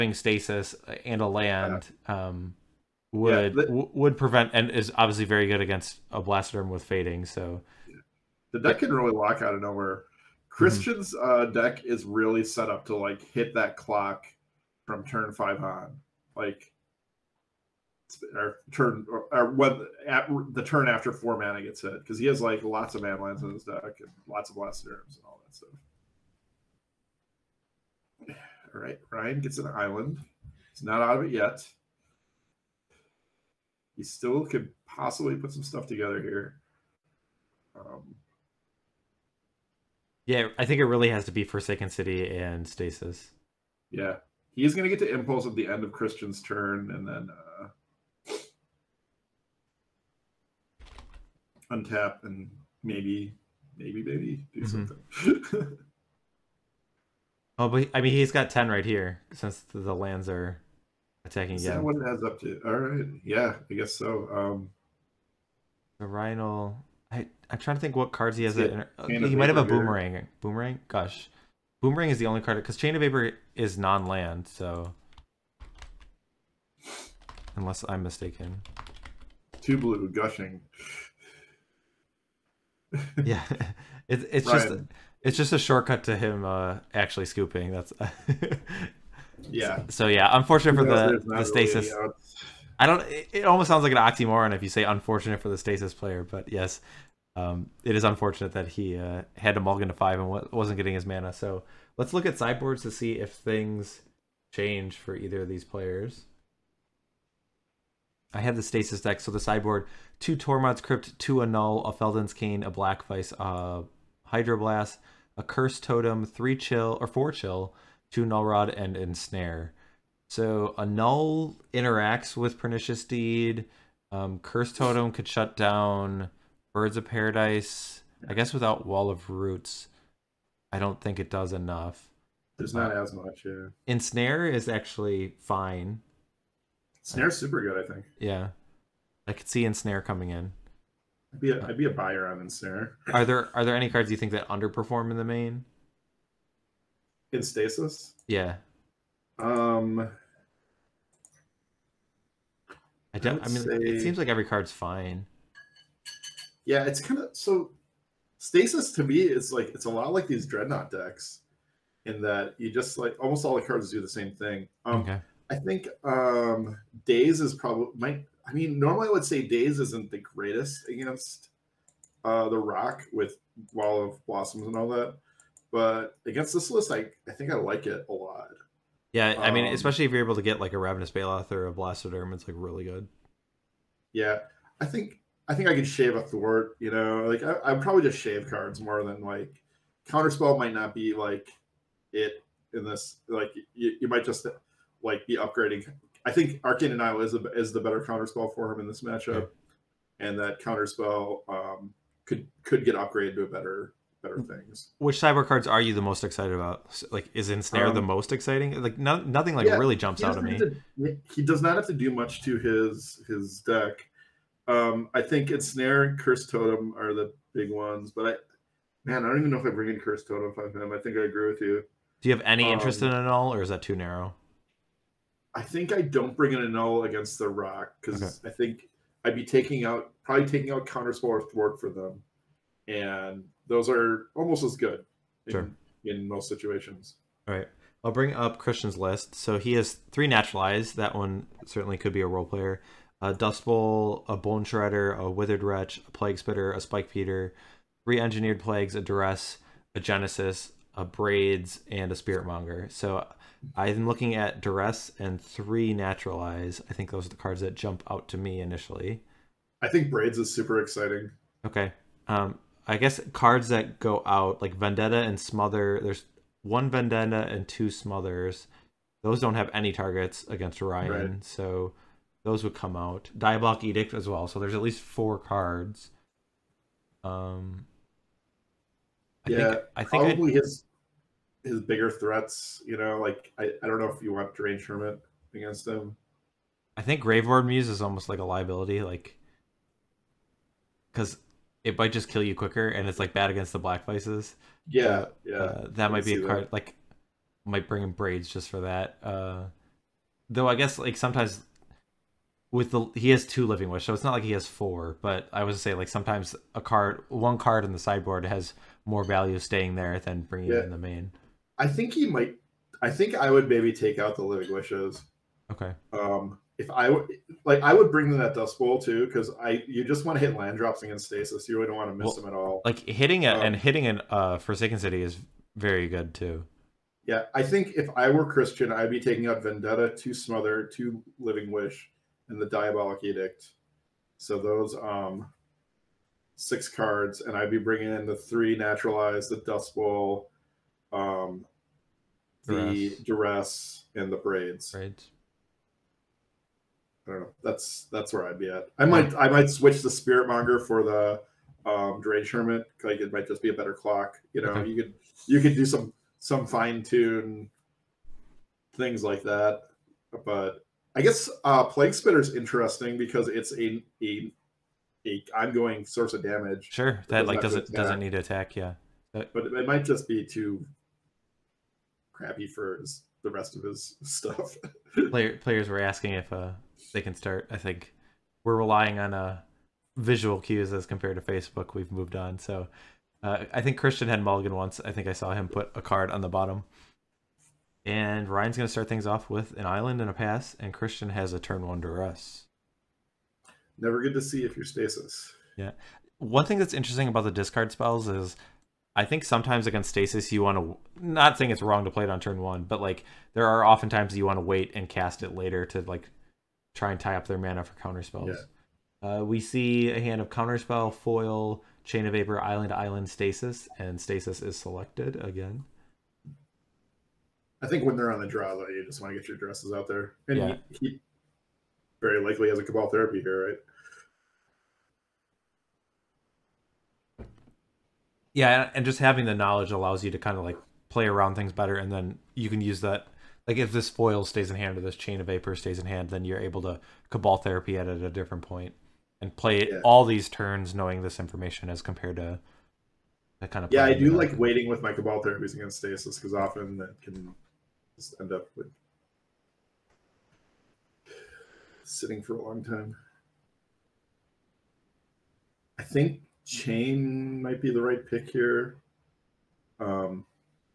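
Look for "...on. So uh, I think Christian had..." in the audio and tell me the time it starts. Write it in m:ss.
6:22.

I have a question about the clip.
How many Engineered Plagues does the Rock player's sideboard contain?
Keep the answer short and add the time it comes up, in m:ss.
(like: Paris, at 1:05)
3, at 4:08.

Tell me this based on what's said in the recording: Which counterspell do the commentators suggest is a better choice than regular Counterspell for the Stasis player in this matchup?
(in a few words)
Arcane Denial.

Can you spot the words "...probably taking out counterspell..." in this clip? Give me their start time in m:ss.
3:50.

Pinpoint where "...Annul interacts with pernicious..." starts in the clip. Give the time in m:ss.
2:00.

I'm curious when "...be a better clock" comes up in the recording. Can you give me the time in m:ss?
5:53.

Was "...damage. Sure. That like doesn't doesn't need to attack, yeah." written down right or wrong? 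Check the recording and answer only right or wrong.
right.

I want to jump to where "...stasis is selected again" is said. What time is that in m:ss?
6:54.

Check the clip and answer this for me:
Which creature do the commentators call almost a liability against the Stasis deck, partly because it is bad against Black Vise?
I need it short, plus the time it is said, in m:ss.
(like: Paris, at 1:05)
Graveyard Muse, at 4:47.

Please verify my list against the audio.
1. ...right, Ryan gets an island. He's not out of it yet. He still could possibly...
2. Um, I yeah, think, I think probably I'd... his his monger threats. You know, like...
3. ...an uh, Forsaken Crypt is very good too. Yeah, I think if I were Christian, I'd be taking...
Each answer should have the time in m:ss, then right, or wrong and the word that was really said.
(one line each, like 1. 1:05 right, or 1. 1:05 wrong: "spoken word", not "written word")
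1. 0:28 right
2. 4:37 wrong: "bigger", not "monger"
3. 5:24 wrong: "City", not "Crypt".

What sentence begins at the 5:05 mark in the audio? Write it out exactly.
But I was say like sometimes a card, one card in the sideboard has more value staying there than bringing yeah.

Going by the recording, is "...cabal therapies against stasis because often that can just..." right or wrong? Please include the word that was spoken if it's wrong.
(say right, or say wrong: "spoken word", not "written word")
right.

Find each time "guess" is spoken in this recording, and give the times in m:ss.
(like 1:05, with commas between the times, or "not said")
1:03, 2:08, 4:22, 5:00, 6:01.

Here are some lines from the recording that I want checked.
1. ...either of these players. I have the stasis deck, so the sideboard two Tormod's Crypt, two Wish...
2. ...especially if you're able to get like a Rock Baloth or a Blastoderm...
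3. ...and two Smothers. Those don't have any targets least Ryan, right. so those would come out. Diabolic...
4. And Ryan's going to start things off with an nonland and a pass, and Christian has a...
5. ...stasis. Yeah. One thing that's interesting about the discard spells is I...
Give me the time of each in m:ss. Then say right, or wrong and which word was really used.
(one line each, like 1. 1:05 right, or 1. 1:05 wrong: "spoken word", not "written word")
1. 1:45 wrong: "Annul", not "Wish"
2. 2:59 wrong: "Ravenous", not "Rock"
3. 4:27 wrong: "against", not "least"
4. 6:28 wrong: "island", not "nonland"
5. 6:34 right.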